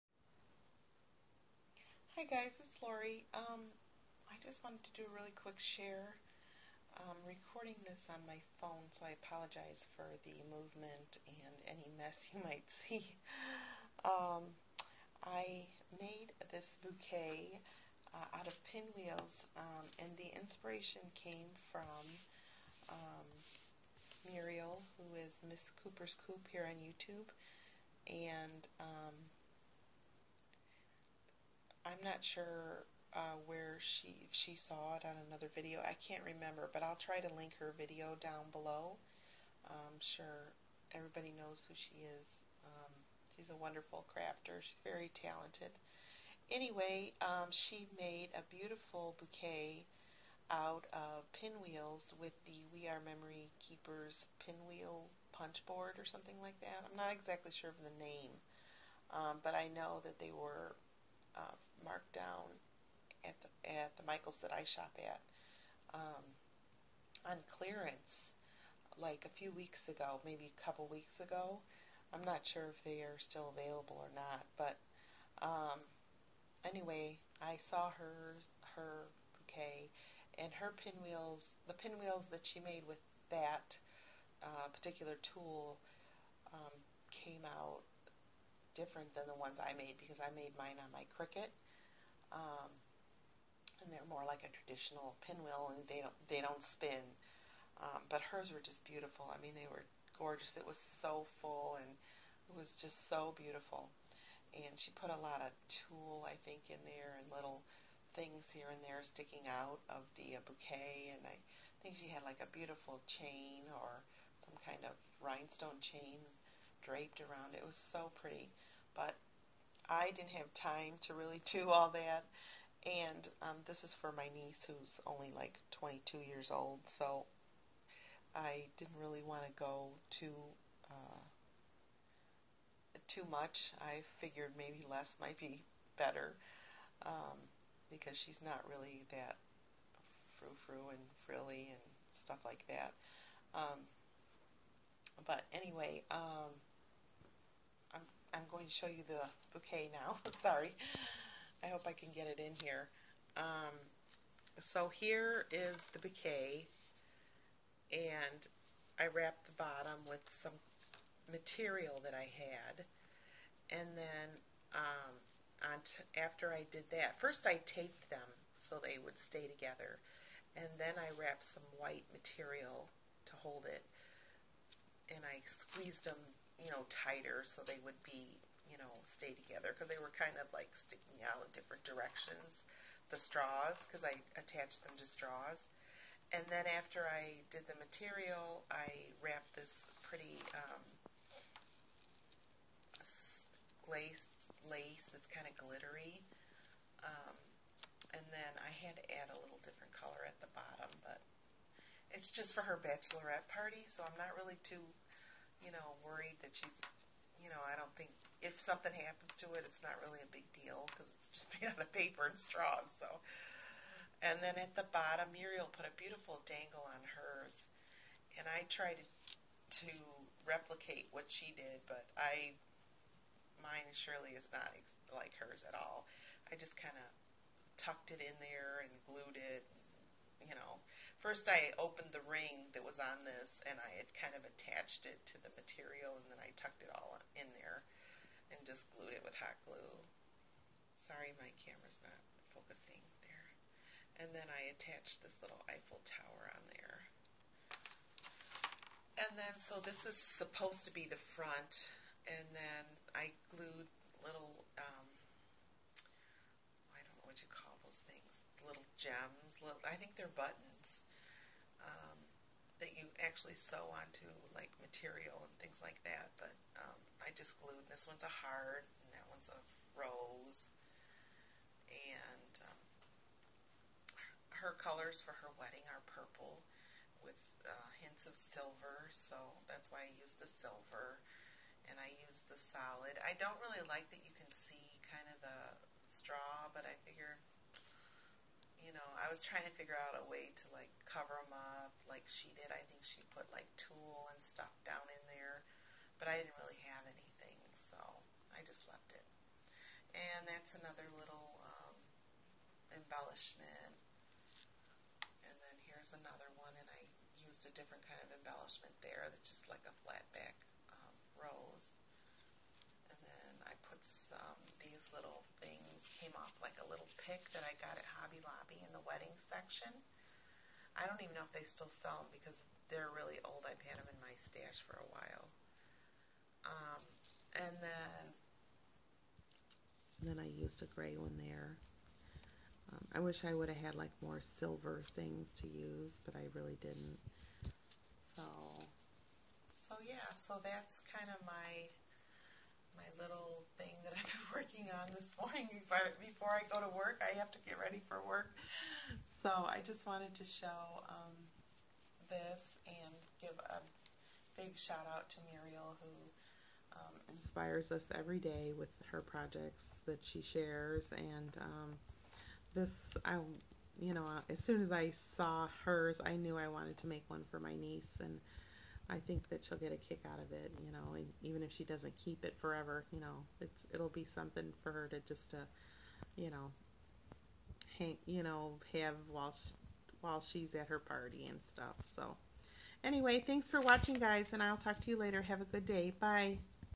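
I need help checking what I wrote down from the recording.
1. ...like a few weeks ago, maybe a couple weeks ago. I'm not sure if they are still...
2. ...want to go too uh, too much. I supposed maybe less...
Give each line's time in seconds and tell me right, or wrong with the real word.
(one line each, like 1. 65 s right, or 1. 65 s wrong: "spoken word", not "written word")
1. 68 s right
2. 129 s wrong: "figured", not "supposed".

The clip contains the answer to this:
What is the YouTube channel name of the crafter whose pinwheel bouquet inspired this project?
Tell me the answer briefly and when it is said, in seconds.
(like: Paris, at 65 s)
Miss Cooper's Coop, at 25 s.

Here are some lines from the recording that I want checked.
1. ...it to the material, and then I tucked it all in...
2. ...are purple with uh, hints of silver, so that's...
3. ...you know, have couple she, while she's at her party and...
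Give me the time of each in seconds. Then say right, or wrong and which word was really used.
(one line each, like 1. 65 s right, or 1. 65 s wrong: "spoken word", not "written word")
1. 235 s right
2. 275 s right
3. 378 s wrong: "while", not "couple".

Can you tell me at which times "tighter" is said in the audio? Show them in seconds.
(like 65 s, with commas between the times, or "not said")
176 s.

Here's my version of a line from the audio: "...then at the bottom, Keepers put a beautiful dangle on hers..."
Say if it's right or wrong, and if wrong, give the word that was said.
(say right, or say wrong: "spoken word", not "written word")
wrong: "Muriel", not "Keepers".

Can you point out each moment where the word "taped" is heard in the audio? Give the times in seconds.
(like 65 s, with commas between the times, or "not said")
167 s.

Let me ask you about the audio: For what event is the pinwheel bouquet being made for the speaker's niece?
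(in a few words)
bachelorette party.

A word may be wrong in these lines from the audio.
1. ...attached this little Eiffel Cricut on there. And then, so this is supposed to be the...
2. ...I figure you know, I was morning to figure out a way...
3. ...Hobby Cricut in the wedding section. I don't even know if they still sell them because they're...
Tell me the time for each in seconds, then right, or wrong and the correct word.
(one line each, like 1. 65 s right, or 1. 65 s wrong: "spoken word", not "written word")
1. 244 s wrong: "Tower", not "Cricut"
2. 286 s wrong: "trying", not "morning"
3. 318 s wrong: "Lobby", not "Cricut".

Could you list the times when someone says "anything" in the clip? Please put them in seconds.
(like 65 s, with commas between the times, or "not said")
297 s.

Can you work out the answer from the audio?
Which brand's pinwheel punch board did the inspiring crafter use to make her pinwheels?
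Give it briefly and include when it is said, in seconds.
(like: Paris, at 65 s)
We Are Memory Keepers, at 52 s.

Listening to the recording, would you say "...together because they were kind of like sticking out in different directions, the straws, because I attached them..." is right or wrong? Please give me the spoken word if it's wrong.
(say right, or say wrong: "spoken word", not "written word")
right.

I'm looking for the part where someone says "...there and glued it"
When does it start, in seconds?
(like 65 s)
228 s.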